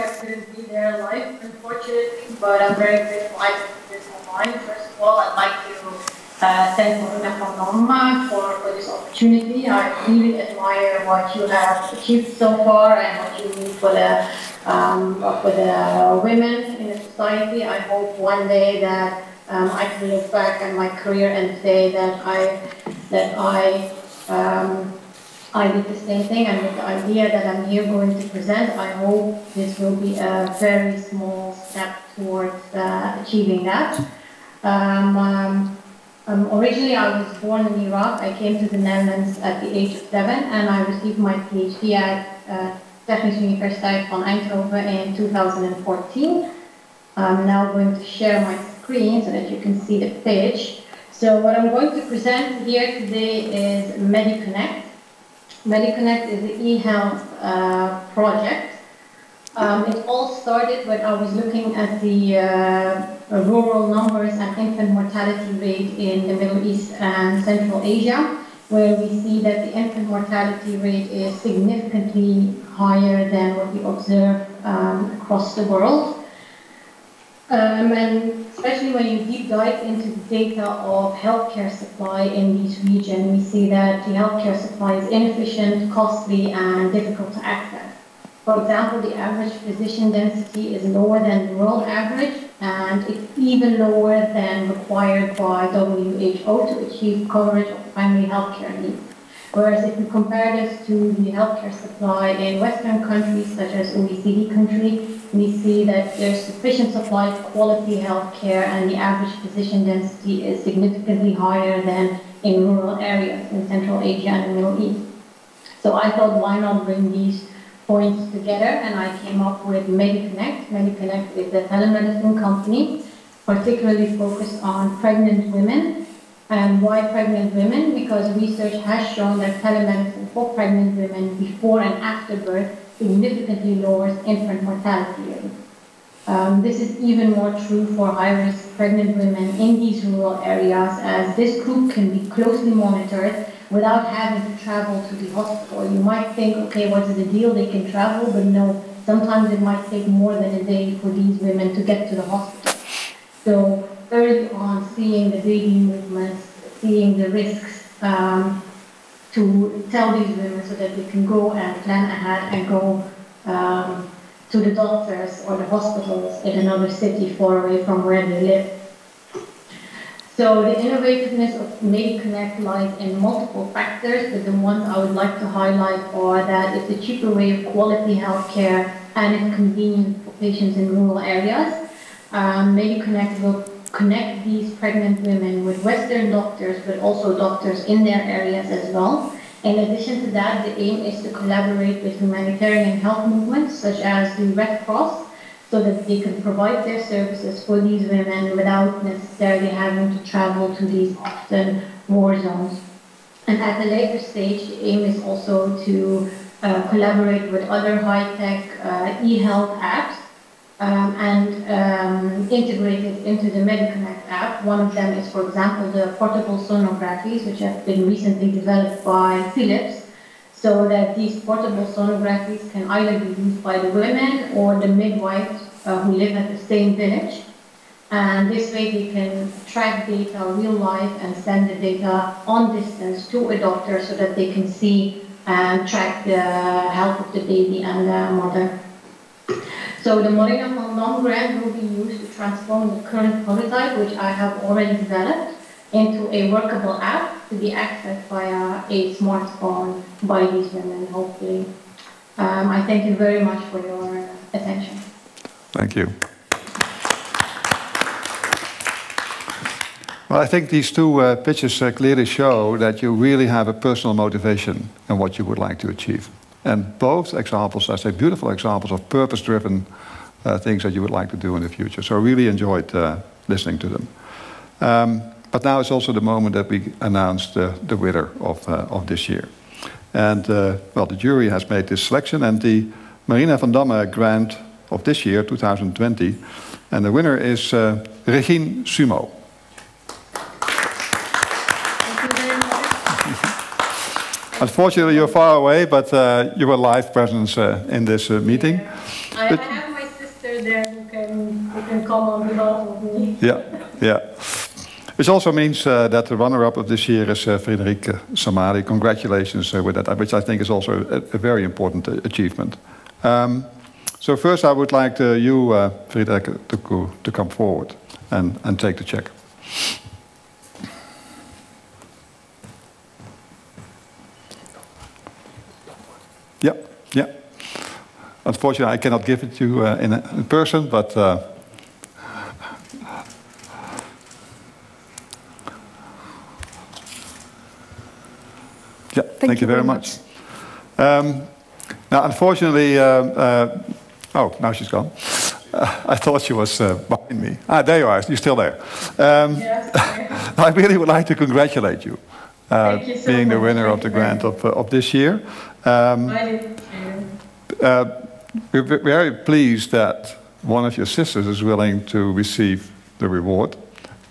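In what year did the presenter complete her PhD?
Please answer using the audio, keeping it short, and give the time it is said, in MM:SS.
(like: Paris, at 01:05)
2014, at 00:45.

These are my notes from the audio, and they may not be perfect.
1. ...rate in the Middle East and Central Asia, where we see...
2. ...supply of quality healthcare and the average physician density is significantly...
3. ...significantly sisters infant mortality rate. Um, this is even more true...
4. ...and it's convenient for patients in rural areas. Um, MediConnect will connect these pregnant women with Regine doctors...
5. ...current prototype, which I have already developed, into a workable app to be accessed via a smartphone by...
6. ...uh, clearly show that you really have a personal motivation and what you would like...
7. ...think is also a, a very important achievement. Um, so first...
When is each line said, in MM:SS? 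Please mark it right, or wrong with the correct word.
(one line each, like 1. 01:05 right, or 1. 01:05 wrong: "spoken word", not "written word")
1. 01:05 right
2. 01:46 right
3. 02:12 wrong: "lowers", not "sisters"
4. 02:59 wrong: "Western", not "Regine"
5. 04:03 right
6. 04:21 right
7. 05:10 right.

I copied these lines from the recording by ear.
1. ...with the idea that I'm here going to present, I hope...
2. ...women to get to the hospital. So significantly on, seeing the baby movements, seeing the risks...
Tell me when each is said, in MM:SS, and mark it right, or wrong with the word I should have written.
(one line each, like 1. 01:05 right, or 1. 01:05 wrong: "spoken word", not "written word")
1. 00:26 right
2. 02:31 wrong: "early", not "significantly".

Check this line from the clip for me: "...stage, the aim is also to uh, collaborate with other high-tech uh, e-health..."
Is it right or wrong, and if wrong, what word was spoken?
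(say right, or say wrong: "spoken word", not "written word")
right.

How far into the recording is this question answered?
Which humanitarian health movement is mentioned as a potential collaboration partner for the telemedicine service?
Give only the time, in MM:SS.
03:14.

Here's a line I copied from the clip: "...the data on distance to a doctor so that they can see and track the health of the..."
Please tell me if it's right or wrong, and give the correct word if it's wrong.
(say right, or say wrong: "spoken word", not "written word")
right.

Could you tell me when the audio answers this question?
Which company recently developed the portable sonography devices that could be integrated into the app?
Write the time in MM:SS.
03:39.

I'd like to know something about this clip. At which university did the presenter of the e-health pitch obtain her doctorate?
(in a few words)
Technische Universiteit van Eindhoven.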